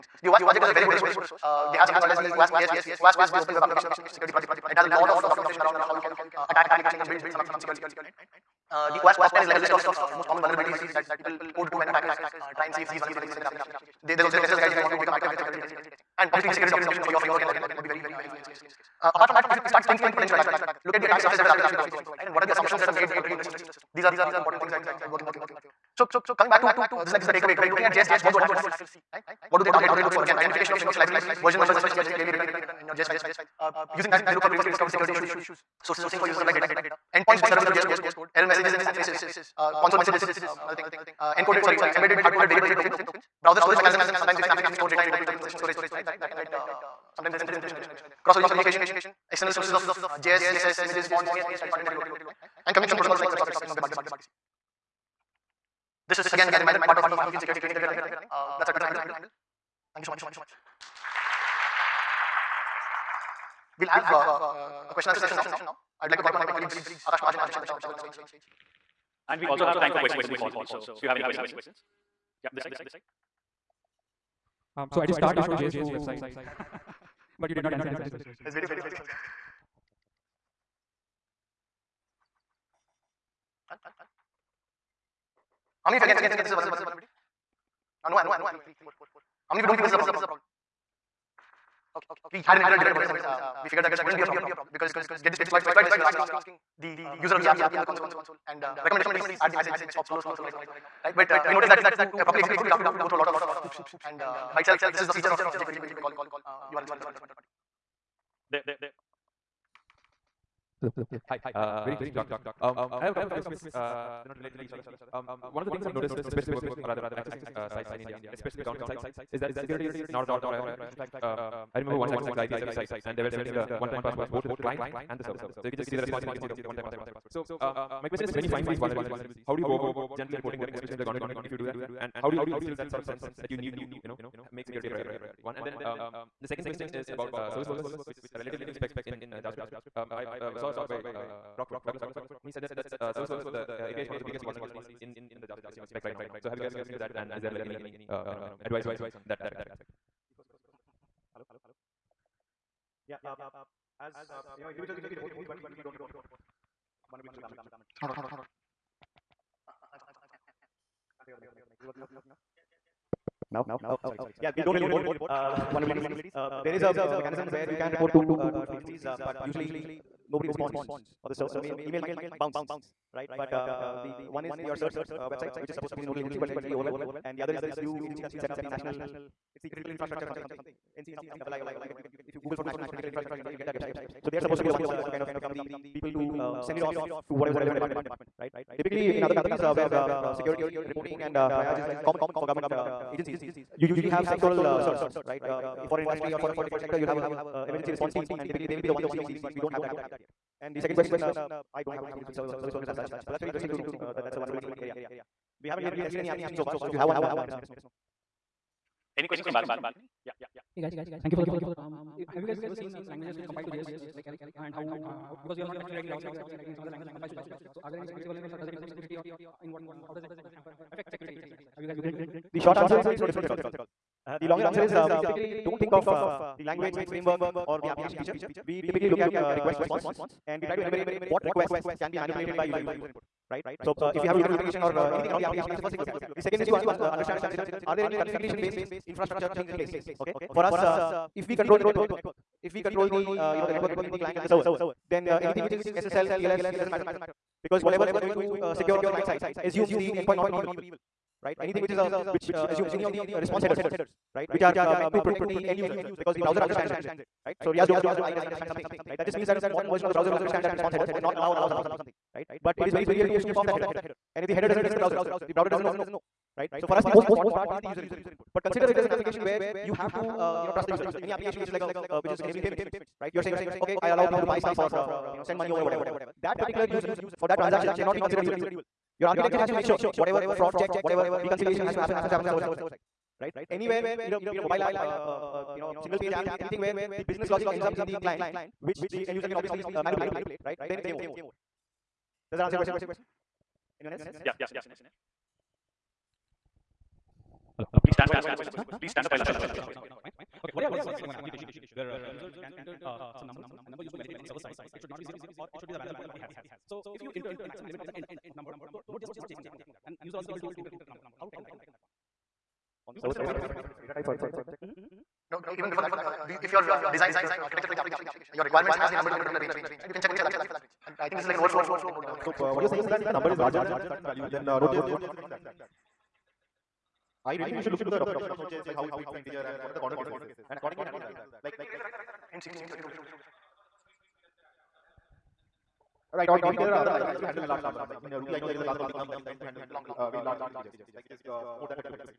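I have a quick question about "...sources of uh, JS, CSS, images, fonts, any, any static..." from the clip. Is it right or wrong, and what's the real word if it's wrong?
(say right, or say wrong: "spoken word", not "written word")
right.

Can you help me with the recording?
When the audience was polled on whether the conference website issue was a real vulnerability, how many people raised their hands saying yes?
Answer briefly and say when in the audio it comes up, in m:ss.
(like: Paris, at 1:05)
3, at 1:28.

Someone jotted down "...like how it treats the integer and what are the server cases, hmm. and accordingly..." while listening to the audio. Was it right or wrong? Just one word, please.
wrong.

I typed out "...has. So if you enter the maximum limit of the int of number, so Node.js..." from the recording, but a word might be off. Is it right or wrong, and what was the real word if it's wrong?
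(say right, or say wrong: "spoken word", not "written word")
right.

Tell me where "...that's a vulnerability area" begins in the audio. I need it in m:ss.
3:24.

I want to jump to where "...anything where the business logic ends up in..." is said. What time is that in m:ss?
4:46.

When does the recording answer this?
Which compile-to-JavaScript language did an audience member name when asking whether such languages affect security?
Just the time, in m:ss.
3:34.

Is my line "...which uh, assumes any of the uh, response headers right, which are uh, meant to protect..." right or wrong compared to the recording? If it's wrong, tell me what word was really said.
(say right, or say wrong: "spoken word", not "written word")
right.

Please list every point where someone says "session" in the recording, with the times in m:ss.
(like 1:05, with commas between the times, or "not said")
0:45, 1:05.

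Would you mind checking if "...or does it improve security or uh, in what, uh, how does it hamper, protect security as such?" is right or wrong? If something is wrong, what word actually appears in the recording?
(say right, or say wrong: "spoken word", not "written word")
wrong: "affect", not "protect".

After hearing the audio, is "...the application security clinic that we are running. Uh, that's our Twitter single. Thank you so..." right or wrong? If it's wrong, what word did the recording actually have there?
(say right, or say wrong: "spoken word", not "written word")
wrong: "handle", not "single".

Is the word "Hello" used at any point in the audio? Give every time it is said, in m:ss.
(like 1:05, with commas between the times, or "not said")
1:50, 2:31, 4:57.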